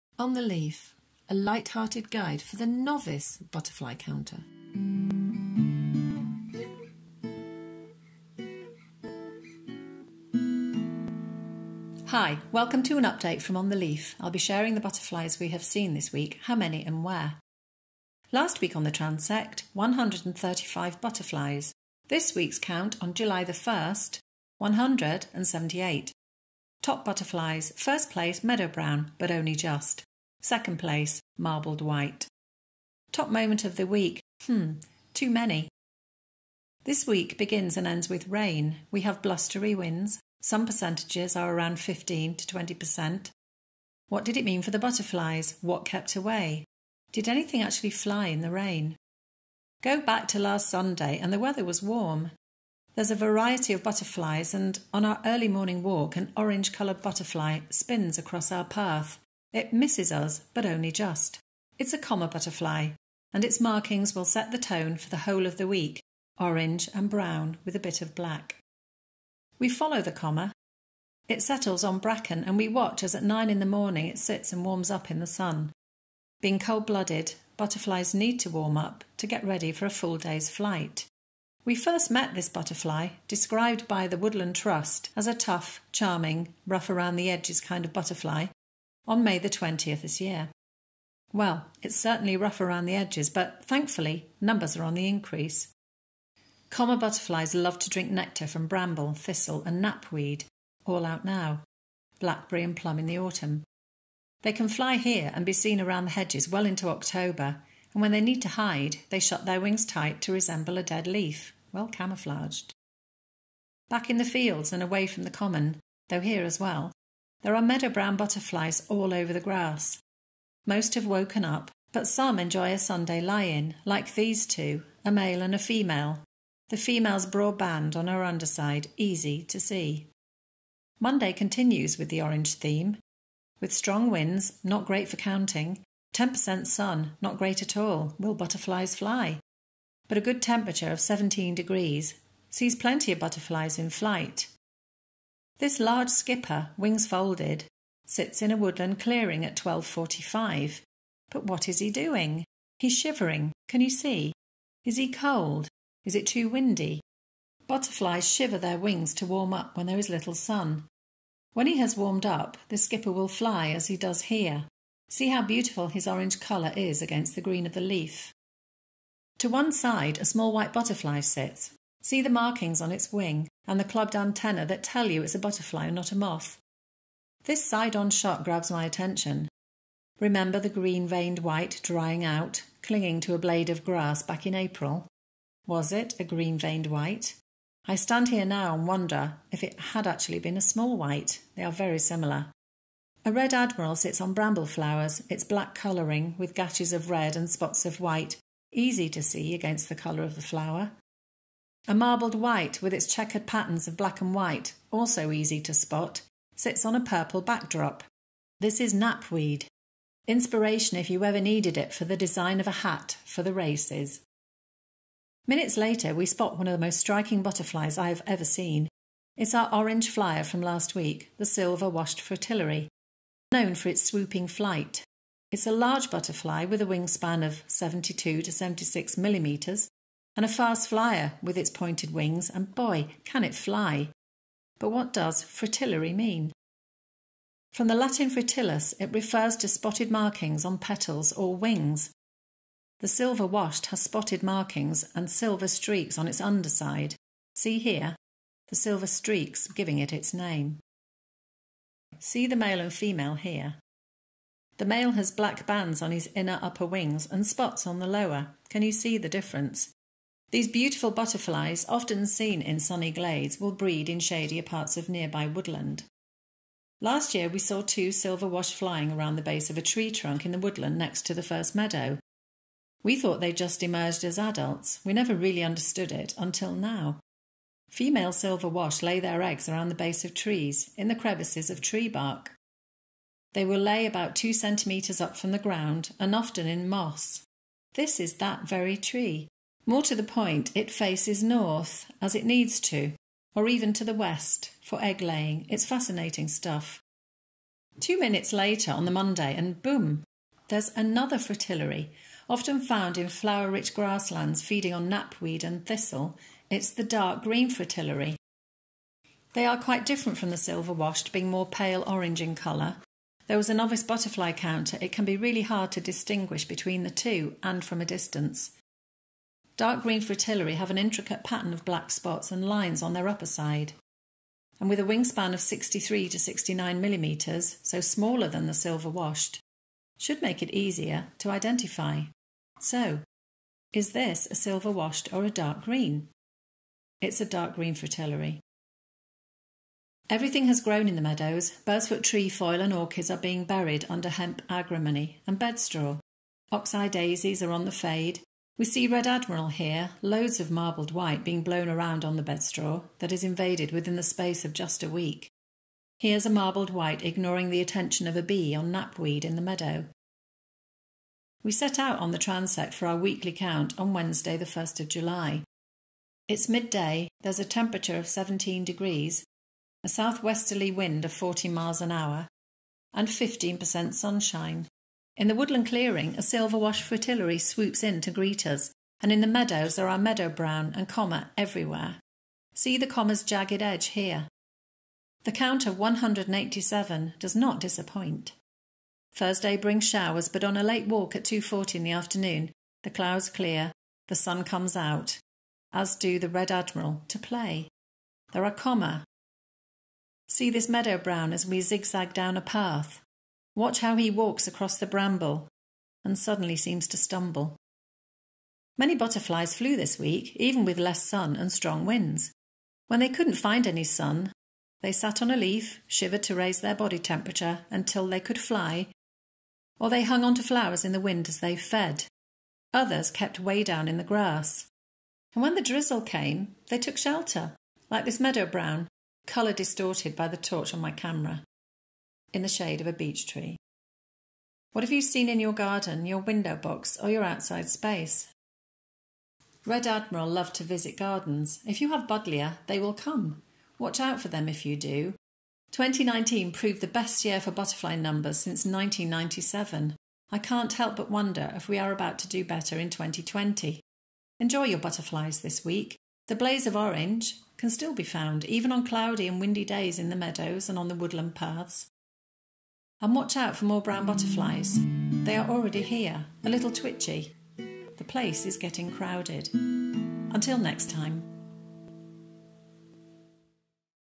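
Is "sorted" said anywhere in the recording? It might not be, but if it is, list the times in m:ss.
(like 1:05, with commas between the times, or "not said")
not said.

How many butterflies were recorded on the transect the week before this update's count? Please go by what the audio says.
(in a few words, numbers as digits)
135.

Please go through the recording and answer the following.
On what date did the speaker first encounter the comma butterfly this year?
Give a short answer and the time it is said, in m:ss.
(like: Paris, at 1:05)
May 20, at 1:29.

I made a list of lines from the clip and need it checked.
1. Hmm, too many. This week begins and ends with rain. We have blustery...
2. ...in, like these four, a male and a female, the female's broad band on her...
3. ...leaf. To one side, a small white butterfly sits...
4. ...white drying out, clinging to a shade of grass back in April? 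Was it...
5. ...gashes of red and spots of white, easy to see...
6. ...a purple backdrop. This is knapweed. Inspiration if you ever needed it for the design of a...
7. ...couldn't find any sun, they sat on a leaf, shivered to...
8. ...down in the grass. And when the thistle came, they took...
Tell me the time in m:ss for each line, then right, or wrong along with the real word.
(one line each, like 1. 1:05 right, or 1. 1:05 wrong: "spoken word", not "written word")
1. 0:34 right
2. 2:03 wrong: "two", not "four"
3. 2:47 right
4. 3:01 wrong: "blade", not "shade"
5. 3:16 right
6. 3:26 right
7. 6:53 right
8. 7:03 wrong: "drizzle", not "thistle".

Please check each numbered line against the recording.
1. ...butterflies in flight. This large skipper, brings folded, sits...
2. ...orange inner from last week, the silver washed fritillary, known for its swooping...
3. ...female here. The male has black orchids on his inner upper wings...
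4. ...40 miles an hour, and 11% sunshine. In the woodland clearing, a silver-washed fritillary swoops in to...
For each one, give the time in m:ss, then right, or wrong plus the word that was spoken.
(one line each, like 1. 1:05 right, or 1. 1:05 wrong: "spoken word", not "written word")
1. 2:23 wrong: "wings", not "brings"
2. 3:39 wrong: "flyer", not "inner"
3. 4:12 wrong: "bands", not "orchids"
4. 6:11 wrong: "15", not "11".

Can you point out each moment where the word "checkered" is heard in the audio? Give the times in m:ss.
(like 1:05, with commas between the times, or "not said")
3:23.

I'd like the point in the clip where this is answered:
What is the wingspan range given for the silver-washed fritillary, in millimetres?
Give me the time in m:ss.
3:47.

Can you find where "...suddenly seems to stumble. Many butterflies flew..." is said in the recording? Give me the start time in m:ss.
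6:46.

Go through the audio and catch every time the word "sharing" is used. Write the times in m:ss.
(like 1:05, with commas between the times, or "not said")
0:14.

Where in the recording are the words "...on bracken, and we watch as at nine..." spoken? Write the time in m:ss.
1:11.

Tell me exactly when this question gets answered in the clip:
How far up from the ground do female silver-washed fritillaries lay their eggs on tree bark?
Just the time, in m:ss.
4:44.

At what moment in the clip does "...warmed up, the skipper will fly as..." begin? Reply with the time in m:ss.
2:41.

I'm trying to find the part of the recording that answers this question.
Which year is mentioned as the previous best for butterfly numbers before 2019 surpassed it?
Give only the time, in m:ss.
7:28.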